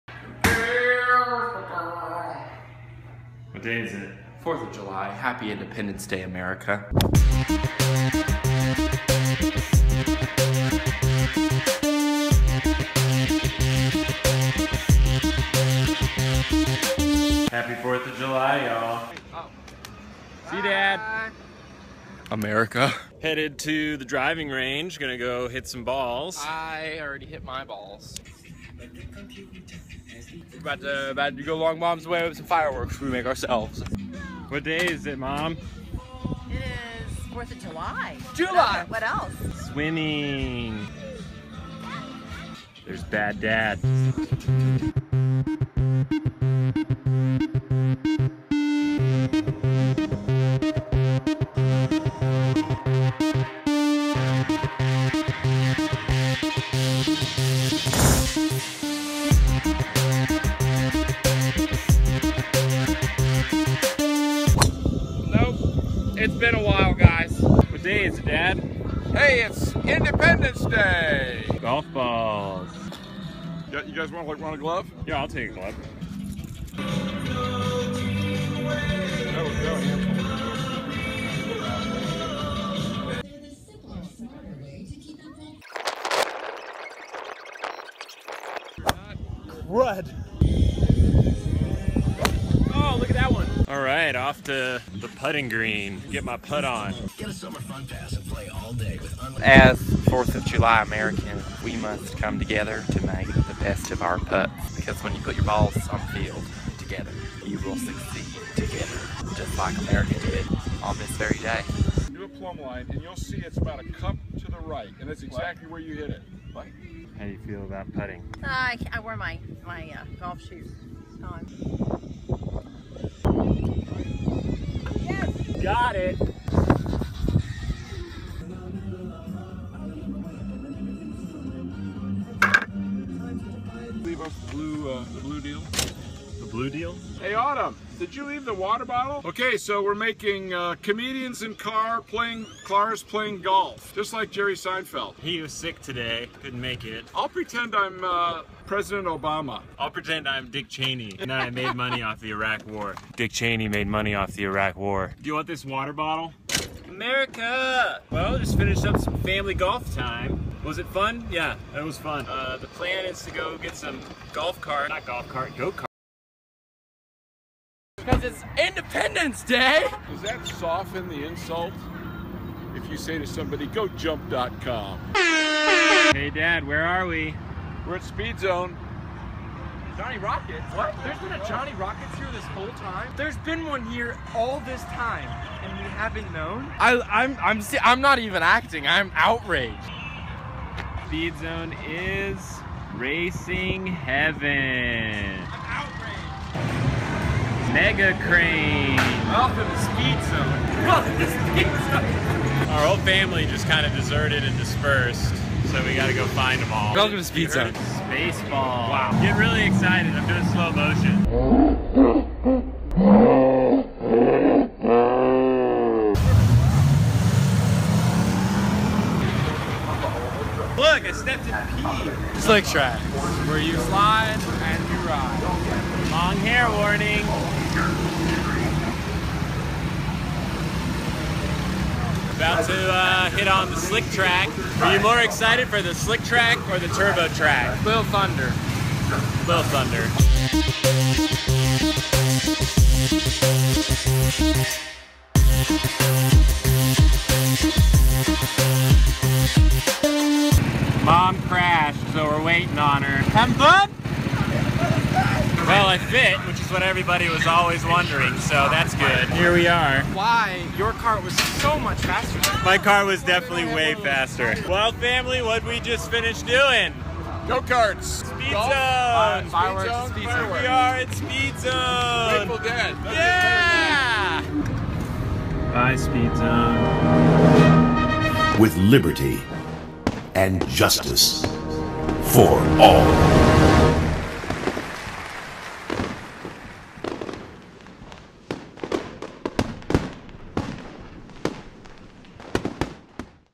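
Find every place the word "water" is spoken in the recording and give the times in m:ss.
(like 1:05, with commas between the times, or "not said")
2:18, 2:35.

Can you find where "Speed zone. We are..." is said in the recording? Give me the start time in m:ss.
4:30.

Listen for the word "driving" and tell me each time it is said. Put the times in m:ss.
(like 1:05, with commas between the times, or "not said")
0:24.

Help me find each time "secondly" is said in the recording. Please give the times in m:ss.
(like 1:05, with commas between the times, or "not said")
not said.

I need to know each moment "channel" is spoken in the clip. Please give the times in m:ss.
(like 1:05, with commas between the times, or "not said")
not said.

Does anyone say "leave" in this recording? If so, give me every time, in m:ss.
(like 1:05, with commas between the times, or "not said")
2:14, 2:18.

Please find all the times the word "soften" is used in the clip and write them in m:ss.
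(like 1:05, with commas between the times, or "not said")
2:50.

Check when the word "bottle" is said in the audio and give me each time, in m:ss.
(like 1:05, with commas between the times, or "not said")
2:18, 2:35.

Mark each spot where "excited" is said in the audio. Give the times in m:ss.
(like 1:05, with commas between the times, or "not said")
3:29, 3:55.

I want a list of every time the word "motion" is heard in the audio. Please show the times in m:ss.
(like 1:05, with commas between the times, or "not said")
3:30.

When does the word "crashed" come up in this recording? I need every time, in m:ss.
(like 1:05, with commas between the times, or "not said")
4:11.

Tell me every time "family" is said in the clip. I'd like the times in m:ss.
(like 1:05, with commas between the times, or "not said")
2:39, 3:22, 4:24.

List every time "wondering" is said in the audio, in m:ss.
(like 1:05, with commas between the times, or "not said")
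4:17.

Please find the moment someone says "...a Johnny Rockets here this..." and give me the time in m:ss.
3:01.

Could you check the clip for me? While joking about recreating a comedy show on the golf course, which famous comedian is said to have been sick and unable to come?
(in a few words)
Jerry Seinfeld.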